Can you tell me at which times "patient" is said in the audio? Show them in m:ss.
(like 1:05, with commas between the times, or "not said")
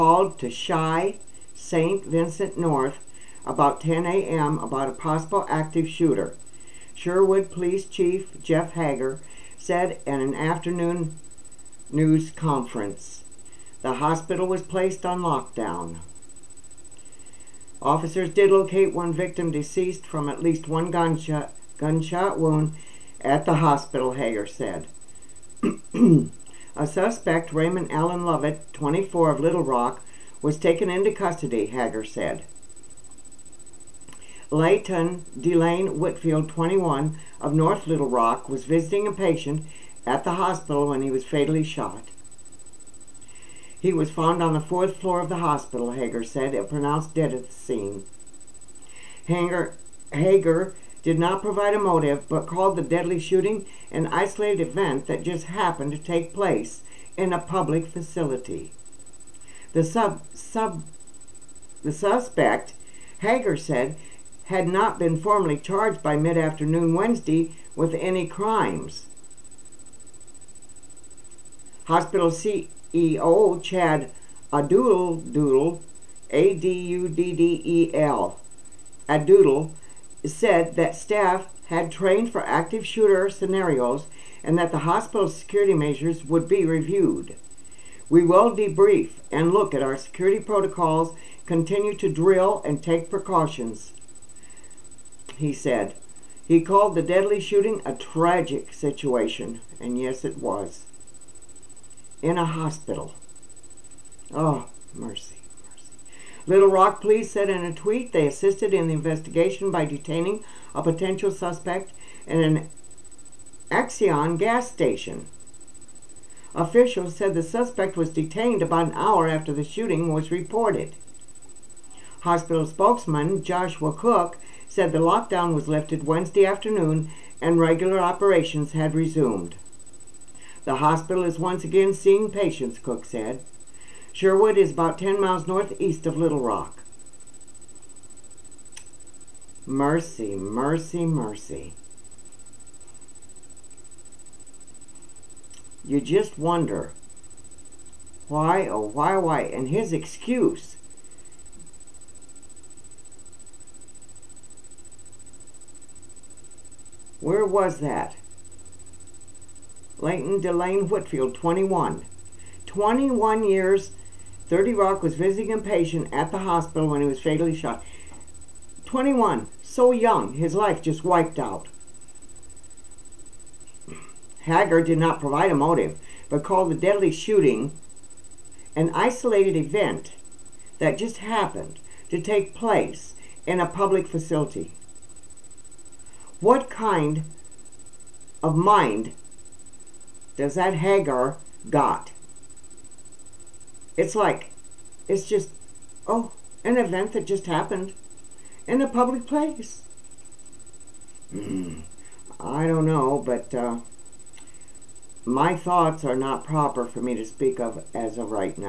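0:39, 2:12, 2:45.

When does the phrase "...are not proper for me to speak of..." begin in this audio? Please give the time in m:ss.
3:26.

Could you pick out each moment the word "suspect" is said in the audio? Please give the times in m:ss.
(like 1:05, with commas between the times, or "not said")
0:26, 1:01, 1:51, 1:57.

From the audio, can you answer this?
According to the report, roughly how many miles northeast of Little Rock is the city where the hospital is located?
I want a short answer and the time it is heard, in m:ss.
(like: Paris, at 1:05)
10, at 2:14.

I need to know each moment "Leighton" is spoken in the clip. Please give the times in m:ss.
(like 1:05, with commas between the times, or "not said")
0:34, 2:39.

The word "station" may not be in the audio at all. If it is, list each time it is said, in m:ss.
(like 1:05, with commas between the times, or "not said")
1:54.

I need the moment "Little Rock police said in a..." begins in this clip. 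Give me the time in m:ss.
1:46.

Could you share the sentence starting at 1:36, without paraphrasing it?
He called the deadly shooting a tragic situation, and yes, it was in a hospital.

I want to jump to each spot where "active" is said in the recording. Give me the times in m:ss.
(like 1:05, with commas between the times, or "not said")
0:05, 1:22.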